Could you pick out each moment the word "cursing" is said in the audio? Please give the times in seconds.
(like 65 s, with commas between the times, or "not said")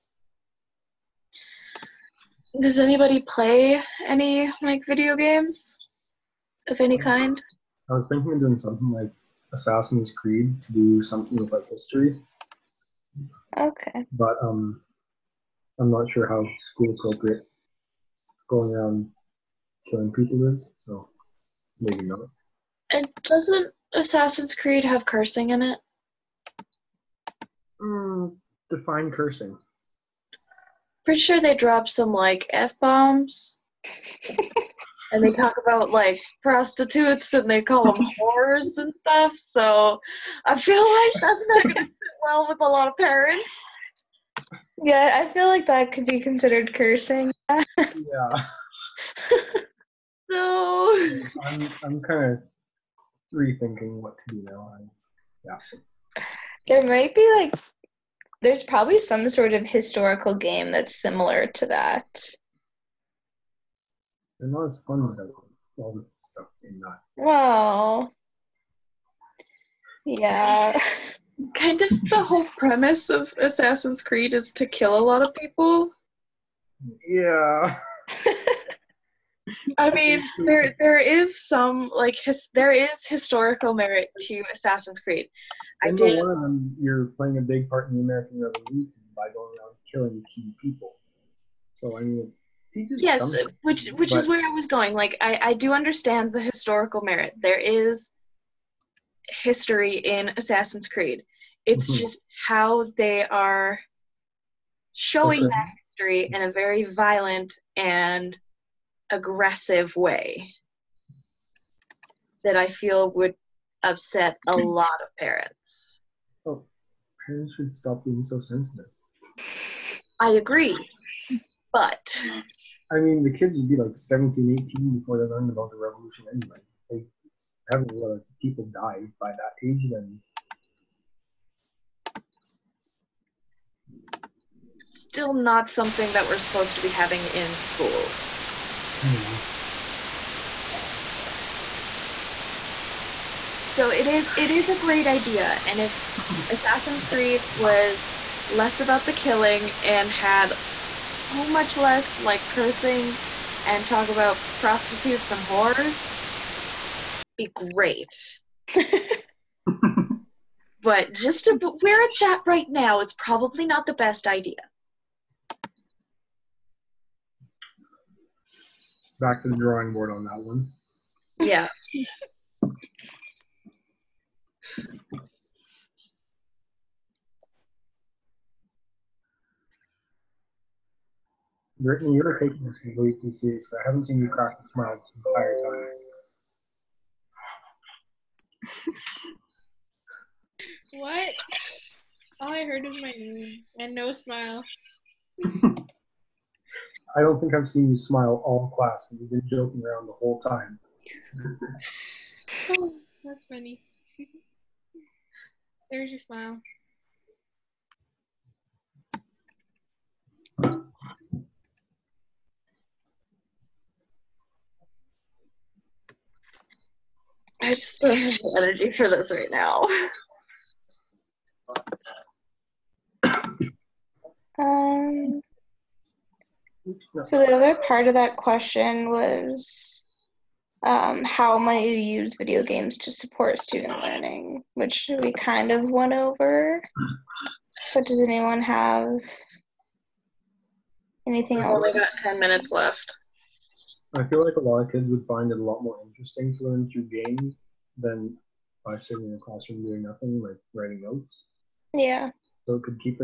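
25 s, 29 s, 46 s, 152 s.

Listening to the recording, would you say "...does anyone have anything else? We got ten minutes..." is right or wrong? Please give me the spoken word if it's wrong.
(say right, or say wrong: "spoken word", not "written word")
right.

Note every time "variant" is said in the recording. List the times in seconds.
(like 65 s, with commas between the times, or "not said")
not said.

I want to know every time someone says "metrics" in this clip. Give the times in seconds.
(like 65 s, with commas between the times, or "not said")
not said.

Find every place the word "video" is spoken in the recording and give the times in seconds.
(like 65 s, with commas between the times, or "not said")
4 s, 232 s.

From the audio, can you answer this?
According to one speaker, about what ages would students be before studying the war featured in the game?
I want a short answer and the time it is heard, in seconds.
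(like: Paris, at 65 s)
17, 18, at 123 s.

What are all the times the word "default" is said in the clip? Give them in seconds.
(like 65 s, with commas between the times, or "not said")
not said.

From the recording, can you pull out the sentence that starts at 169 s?
Back to the drawing board on that one.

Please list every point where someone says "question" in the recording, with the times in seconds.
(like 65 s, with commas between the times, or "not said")
228 s.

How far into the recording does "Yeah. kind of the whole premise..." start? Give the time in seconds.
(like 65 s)
70 s.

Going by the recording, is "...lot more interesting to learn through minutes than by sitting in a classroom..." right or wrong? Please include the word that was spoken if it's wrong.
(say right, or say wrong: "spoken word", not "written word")
wrong: "games", not "minutes".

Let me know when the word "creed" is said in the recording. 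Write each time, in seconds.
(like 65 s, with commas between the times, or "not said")
10 s, 24 s, 74 s, 84 s, 100 s, 147 s.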